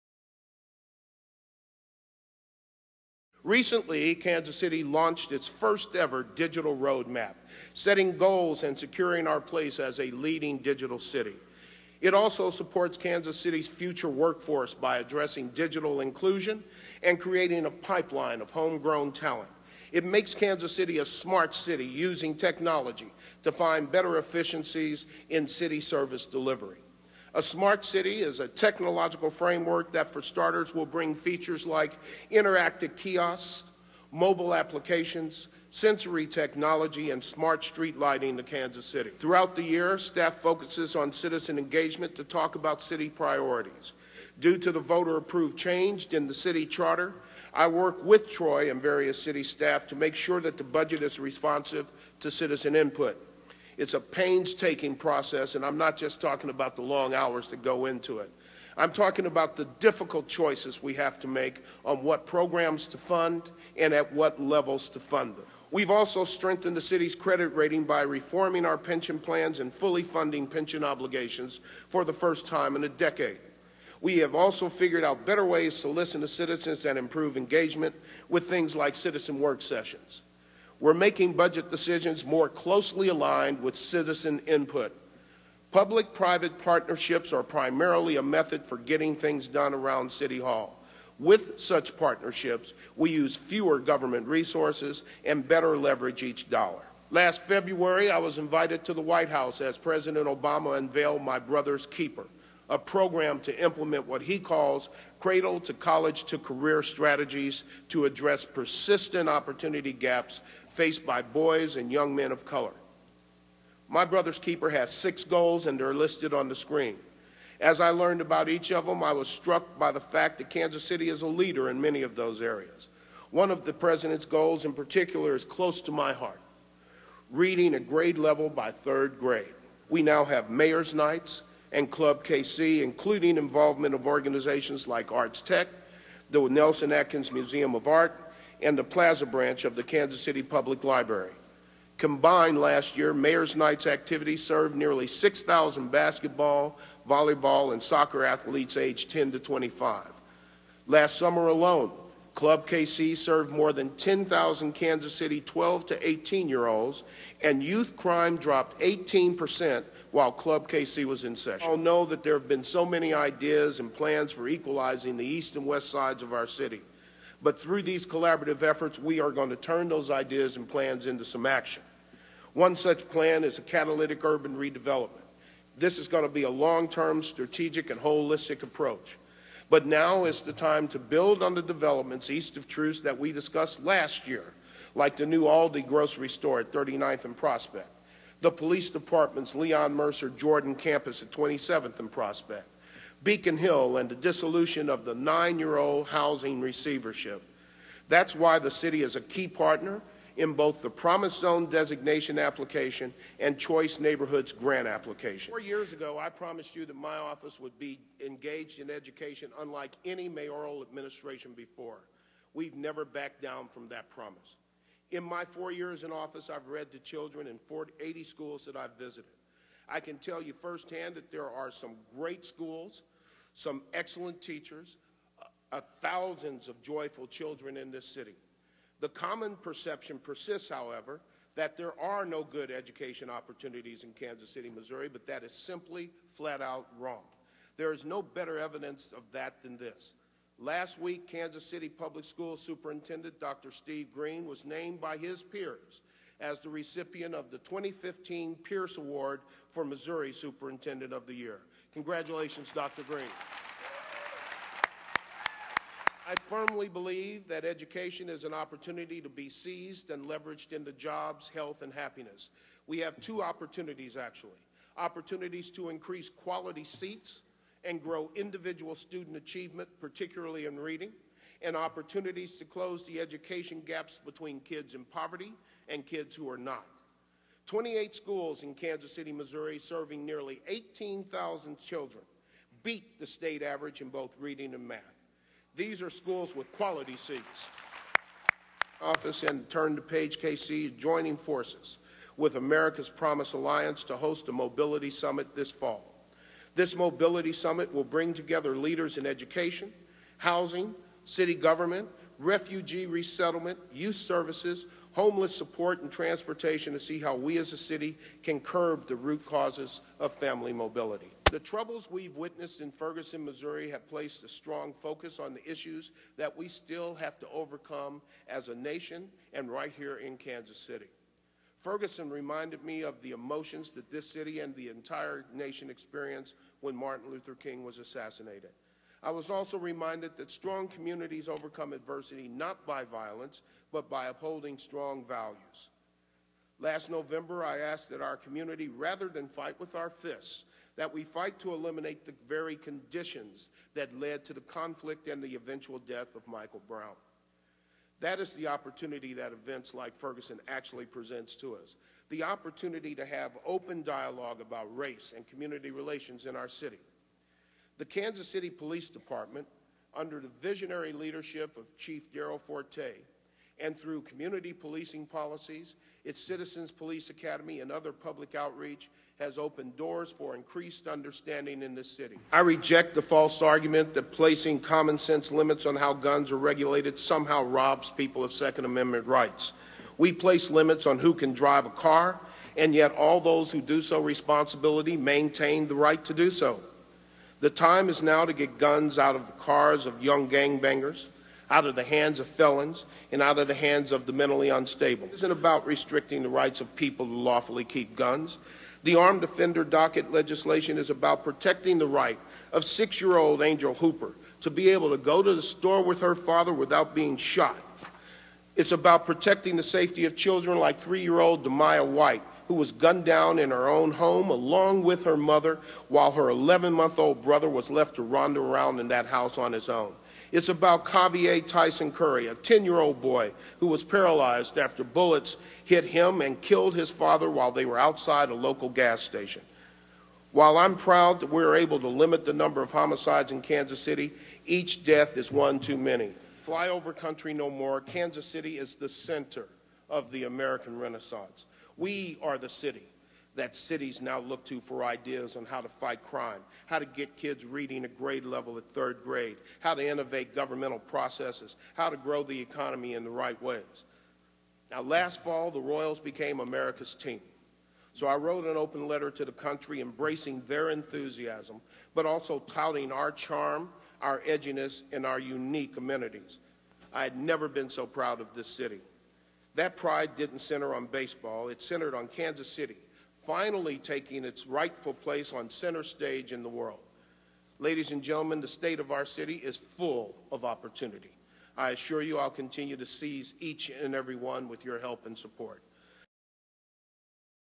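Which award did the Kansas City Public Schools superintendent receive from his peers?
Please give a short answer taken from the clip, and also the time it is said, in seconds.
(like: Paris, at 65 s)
Pierce Award, at 248 s.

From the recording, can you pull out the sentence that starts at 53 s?
It's a painstaking process, and I'm not just talking about the long hours that go into it.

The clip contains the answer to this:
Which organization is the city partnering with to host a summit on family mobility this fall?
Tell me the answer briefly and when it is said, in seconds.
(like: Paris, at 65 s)
America's Promise Alliance, at 292 s.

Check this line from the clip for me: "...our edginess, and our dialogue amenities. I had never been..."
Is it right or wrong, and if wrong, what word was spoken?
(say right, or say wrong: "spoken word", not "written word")
wrong: "unique", not "dialogue".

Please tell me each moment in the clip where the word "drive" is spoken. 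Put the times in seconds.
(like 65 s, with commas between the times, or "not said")
381 s.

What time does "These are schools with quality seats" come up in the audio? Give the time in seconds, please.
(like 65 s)
285 s.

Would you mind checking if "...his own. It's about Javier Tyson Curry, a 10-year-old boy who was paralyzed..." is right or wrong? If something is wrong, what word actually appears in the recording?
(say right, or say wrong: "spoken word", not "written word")
right.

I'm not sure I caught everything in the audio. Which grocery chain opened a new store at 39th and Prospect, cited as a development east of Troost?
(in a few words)
Aldi.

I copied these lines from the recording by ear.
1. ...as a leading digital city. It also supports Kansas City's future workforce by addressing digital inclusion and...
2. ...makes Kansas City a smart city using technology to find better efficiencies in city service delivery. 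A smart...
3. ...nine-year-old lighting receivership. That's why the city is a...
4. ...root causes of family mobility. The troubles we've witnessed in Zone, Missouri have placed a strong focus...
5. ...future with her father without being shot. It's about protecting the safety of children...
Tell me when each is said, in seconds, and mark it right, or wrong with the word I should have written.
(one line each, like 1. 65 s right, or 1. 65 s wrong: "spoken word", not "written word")
1. 9 s right
2. 20 s right
3. 195 s wrong: "housing", not "lighting"
4. 309 s wrong: "Ferguson", not "Zone"
5. 405 s wrong: "store", not "future".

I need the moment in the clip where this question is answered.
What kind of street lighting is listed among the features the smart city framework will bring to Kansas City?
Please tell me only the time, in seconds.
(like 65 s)
37 s.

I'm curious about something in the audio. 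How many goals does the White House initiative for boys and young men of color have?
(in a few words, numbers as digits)
6.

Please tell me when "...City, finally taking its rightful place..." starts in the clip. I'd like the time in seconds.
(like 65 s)
472 s.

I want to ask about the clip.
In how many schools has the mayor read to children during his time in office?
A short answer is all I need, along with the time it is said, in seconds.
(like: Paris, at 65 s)
80, at 218 s.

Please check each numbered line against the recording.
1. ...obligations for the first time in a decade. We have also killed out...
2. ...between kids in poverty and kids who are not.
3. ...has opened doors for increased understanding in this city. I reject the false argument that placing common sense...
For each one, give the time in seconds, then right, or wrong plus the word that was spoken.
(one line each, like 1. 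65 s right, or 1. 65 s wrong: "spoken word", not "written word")
1. 70 s wrong: "figured", not "killed"
2. 274 s right
3. 369 s right.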